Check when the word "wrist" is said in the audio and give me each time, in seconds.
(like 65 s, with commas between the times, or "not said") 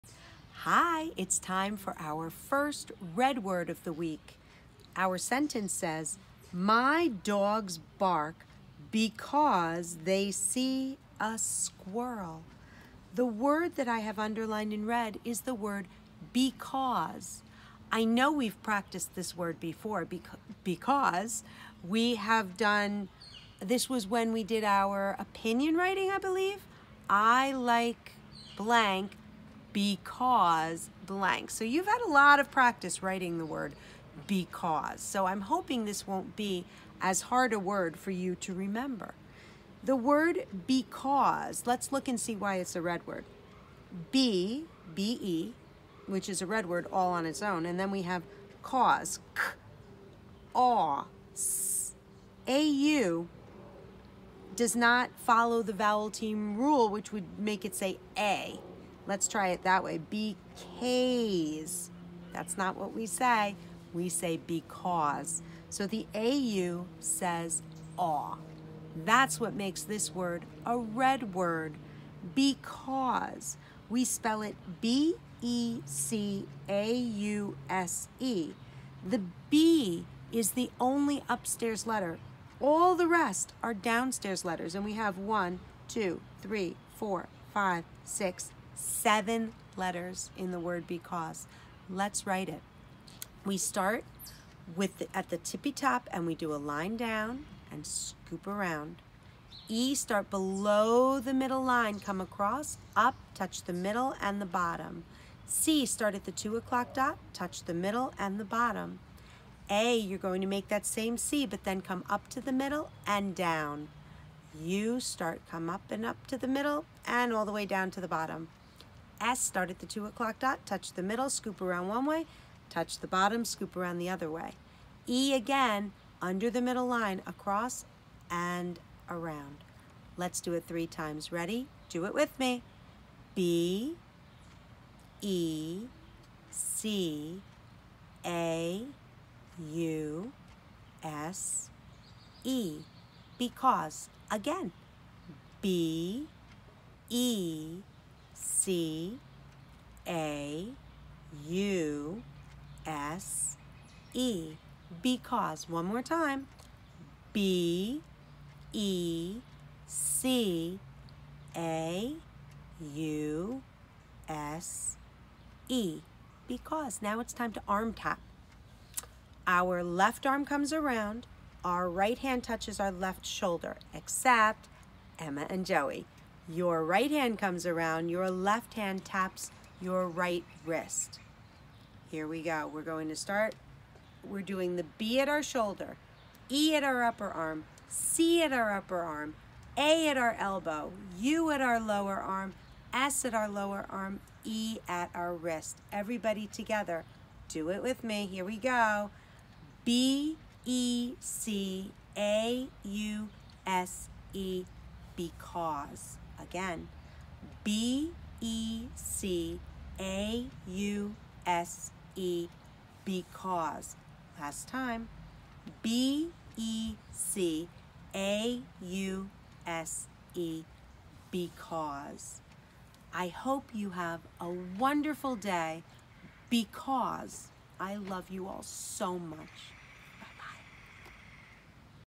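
180 s, 195 s.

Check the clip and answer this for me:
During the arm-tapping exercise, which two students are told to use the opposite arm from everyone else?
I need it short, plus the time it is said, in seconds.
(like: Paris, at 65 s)
Emma and Joey, at 175 s.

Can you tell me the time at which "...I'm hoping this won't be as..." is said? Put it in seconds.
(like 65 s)
35 s.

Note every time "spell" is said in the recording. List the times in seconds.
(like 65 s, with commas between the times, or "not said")
74 s.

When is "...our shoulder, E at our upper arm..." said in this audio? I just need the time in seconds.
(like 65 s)
185 s.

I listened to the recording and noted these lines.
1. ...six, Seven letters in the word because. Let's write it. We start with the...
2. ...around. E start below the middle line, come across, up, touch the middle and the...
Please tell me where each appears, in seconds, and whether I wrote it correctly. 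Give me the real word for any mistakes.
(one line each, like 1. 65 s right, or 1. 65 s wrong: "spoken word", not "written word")
1. 88 s right
2. 98 s right.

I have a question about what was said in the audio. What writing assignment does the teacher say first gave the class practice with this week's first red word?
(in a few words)
opinion writing.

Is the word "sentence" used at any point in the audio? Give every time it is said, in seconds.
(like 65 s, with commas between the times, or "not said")
5 s.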